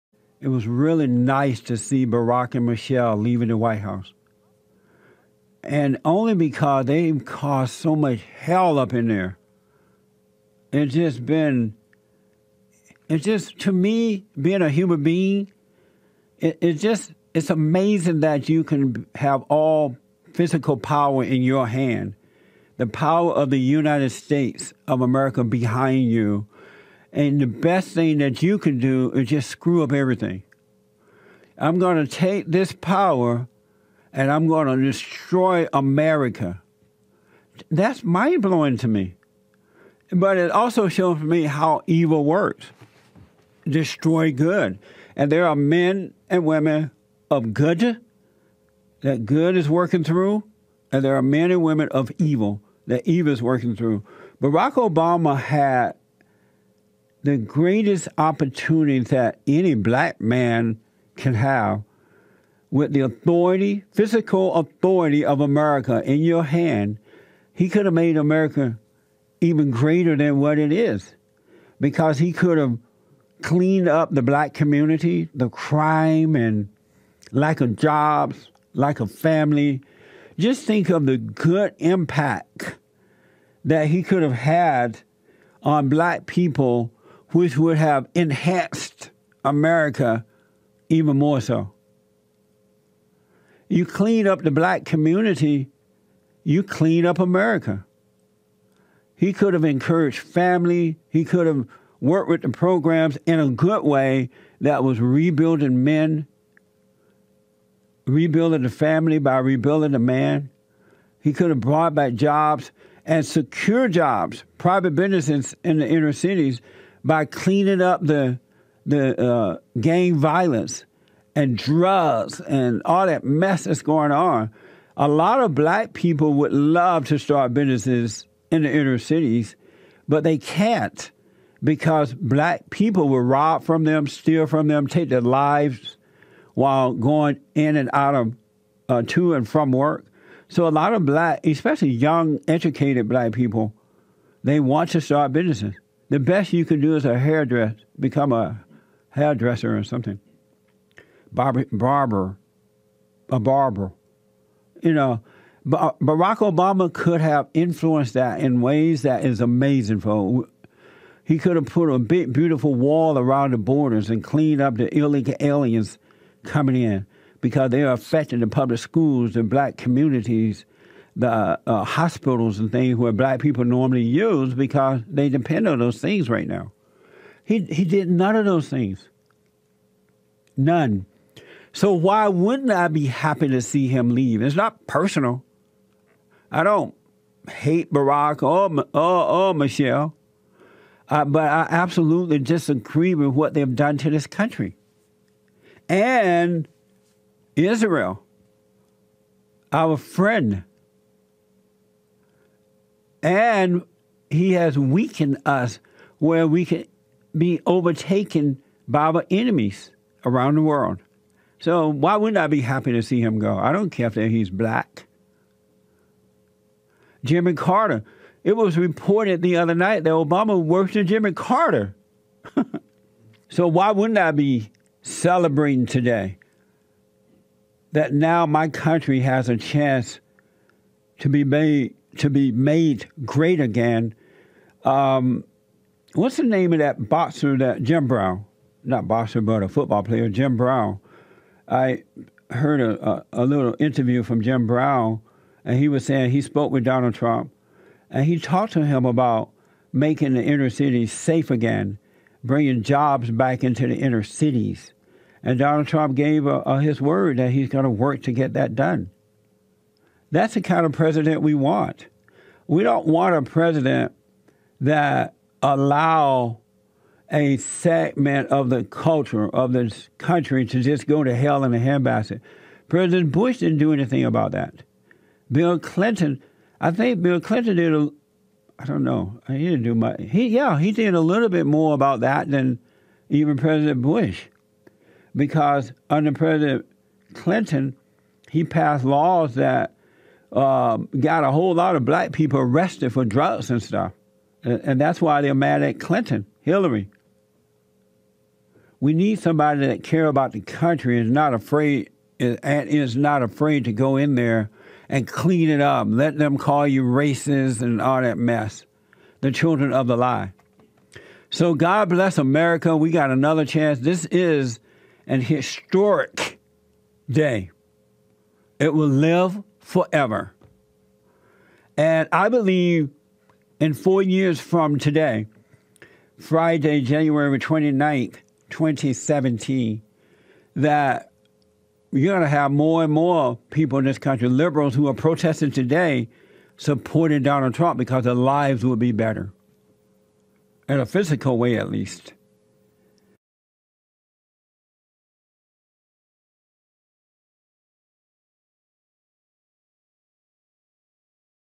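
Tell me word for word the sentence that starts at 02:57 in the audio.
He, he did none of those things.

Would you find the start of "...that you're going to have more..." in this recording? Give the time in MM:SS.
05:30.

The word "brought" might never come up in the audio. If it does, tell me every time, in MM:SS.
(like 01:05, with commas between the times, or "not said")
01:51.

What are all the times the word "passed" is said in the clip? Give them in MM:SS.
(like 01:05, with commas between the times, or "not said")
04:48.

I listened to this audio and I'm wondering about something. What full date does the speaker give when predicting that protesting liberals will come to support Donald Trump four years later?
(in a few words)
Friday, January 29th, 2017.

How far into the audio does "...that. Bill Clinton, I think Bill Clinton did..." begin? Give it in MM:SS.
04:34.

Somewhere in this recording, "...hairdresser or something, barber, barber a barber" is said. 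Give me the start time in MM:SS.
02:29.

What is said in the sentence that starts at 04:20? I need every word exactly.
That's the kind of president we want.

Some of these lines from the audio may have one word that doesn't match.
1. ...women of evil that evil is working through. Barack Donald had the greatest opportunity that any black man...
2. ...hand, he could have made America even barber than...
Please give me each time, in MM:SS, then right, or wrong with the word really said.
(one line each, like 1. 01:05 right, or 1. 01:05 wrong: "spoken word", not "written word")
1. 00:51 wrong: "Obama", not "Donald"
2. 01:06 wrong: "greater", not "barber".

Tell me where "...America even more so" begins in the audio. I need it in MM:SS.
01:29.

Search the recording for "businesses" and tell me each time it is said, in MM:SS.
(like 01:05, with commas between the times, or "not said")
01:54, 02:07, 02:25.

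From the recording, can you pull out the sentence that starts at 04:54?
And, and that's why they're mad at Clinton, Hillary.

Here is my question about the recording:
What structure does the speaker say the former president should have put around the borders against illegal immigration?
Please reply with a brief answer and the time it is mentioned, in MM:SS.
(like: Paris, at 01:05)
a big, beautiful wall, at 02:41.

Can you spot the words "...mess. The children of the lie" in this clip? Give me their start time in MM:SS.
05:08.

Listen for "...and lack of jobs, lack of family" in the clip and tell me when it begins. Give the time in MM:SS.
01:16.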